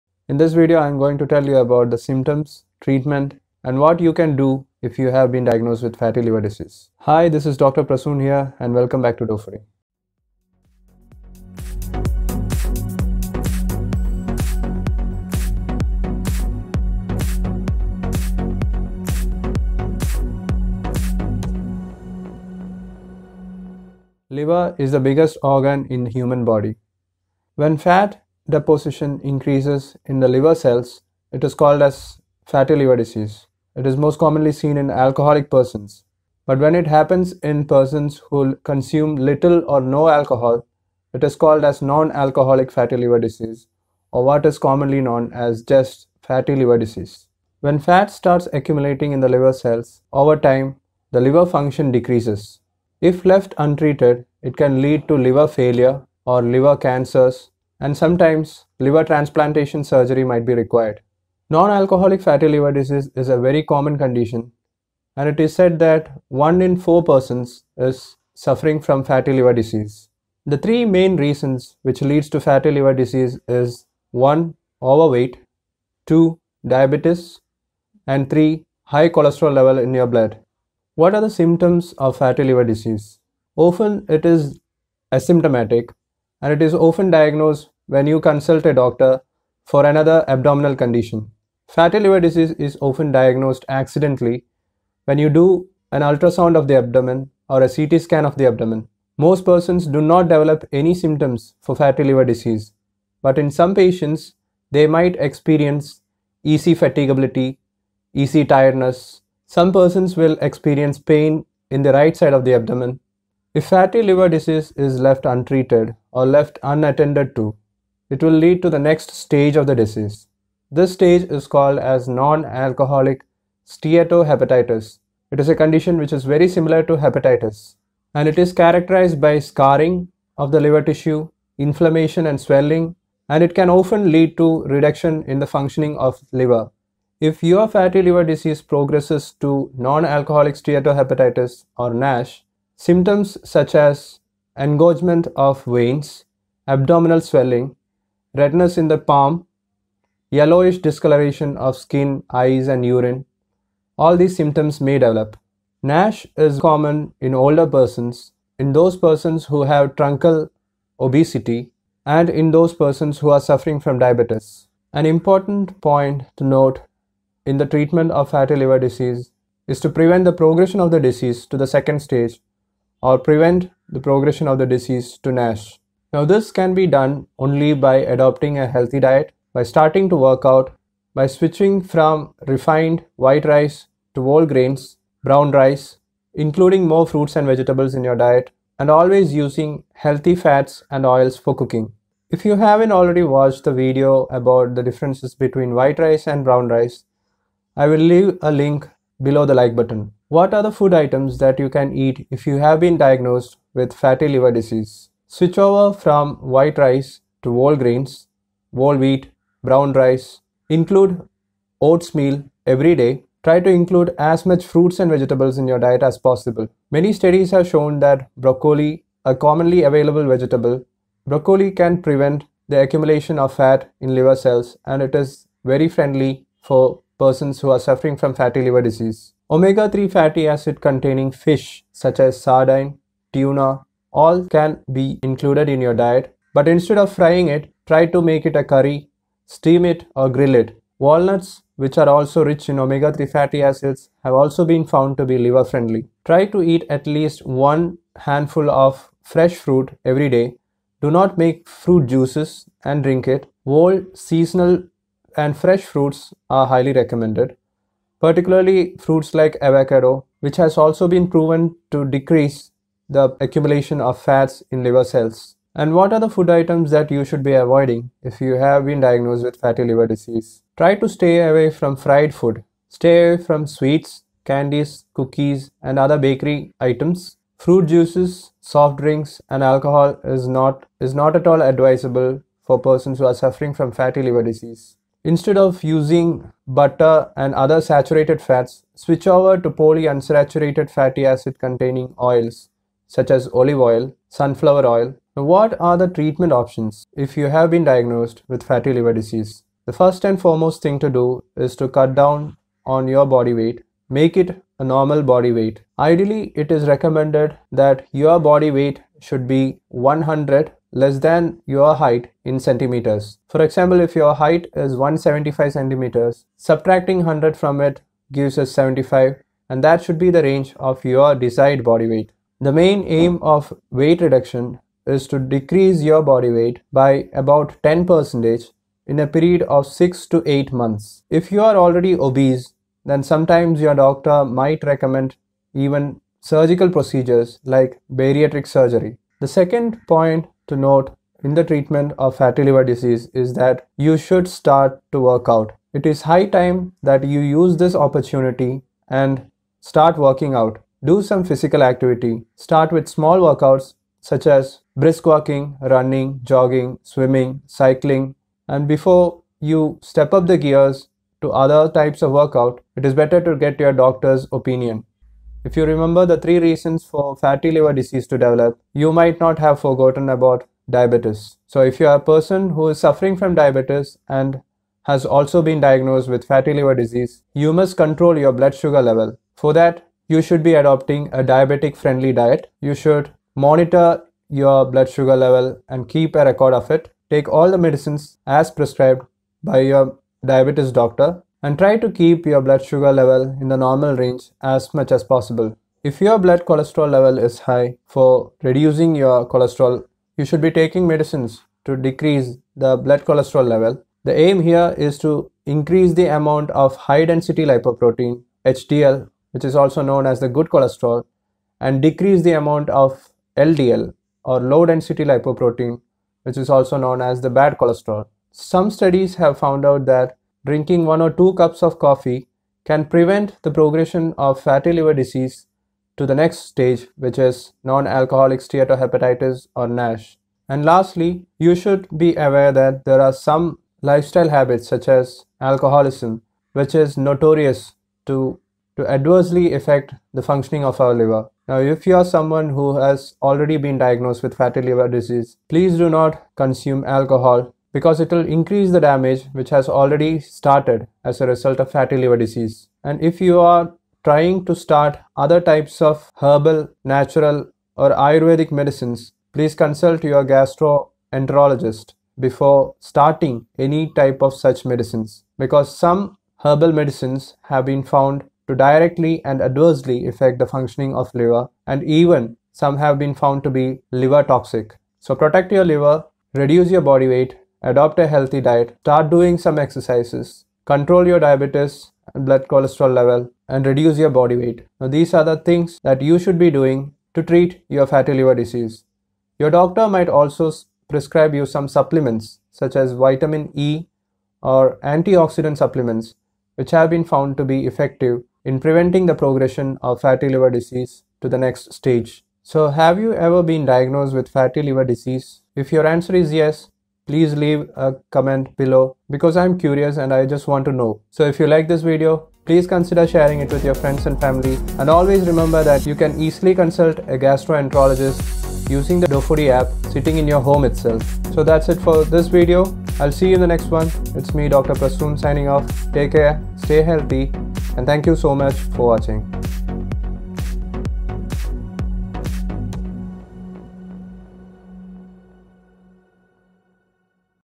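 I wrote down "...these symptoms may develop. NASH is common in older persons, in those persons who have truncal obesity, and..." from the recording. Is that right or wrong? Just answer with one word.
right.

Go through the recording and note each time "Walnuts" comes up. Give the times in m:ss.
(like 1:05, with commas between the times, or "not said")
4:00.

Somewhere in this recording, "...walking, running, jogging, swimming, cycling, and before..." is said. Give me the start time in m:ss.
5:55.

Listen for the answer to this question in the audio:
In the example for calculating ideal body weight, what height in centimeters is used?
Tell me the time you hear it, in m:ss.
5:14.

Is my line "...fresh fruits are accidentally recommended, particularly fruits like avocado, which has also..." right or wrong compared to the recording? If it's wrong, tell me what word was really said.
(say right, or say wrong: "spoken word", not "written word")
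wrong: "highly", not "accidentally".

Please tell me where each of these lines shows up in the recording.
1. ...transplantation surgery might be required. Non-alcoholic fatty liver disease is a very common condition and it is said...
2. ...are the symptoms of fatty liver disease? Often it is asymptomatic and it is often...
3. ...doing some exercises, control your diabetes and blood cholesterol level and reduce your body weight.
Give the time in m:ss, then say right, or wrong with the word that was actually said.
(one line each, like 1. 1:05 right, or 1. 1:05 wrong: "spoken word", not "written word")
1. 0:59 right
2. 1:21 right
3. 7:59 right.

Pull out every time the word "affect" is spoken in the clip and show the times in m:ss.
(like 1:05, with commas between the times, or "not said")
7:19, 7:50.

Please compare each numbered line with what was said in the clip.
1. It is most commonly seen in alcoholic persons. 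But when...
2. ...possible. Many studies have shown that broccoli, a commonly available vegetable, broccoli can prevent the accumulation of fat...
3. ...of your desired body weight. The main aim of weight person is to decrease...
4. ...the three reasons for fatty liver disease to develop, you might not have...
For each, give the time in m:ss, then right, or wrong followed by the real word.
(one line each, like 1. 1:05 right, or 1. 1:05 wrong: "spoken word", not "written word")
1. 0:33 right
2. 3:36 right
3. 5:20 wrong: "reduction", not "person"
4. 6:06 right.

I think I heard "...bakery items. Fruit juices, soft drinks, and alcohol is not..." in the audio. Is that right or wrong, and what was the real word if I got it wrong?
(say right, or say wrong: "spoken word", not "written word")
right.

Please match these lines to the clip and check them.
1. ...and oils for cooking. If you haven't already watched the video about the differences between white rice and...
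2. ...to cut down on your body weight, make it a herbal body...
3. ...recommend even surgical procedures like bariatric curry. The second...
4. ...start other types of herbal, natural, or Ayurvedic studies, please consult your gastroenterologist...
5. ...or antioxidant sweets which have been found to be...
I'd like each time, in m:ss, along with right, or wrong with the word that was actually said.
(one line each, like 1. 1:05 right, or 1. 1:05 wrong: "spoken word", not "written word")
1. 3:10 right
2. 5:01 wrong: "normal", not "herbal"
3. 5:34 wrong: "surgery", not "curry"
4. 7:34 wrong: "medicines", not "studies"
5. 8:14 wrong: "supplements", not "sweets".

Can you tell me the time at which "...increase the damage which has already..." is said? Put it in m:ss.
7:28.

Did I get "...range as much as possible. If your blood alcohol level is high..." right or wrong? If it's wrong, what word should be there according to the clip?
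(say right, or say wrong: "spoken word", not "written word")
wrong: "cholesterol", not "alcohol".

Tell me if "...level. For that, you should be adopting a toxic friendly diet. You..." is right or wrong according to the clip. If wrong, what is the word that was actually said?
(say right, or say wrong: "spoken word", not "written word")
wrong: "diabetic", not "toxic".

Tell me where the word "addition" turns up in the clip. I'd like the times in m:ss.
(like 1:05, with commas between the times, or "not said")
not said.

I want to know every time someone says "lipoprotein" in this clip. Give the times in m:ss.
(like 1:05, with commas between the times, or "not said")
6:47, 6:55.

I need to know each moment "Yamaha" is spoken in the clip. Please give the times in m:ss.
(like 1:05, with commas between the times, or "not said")
not said.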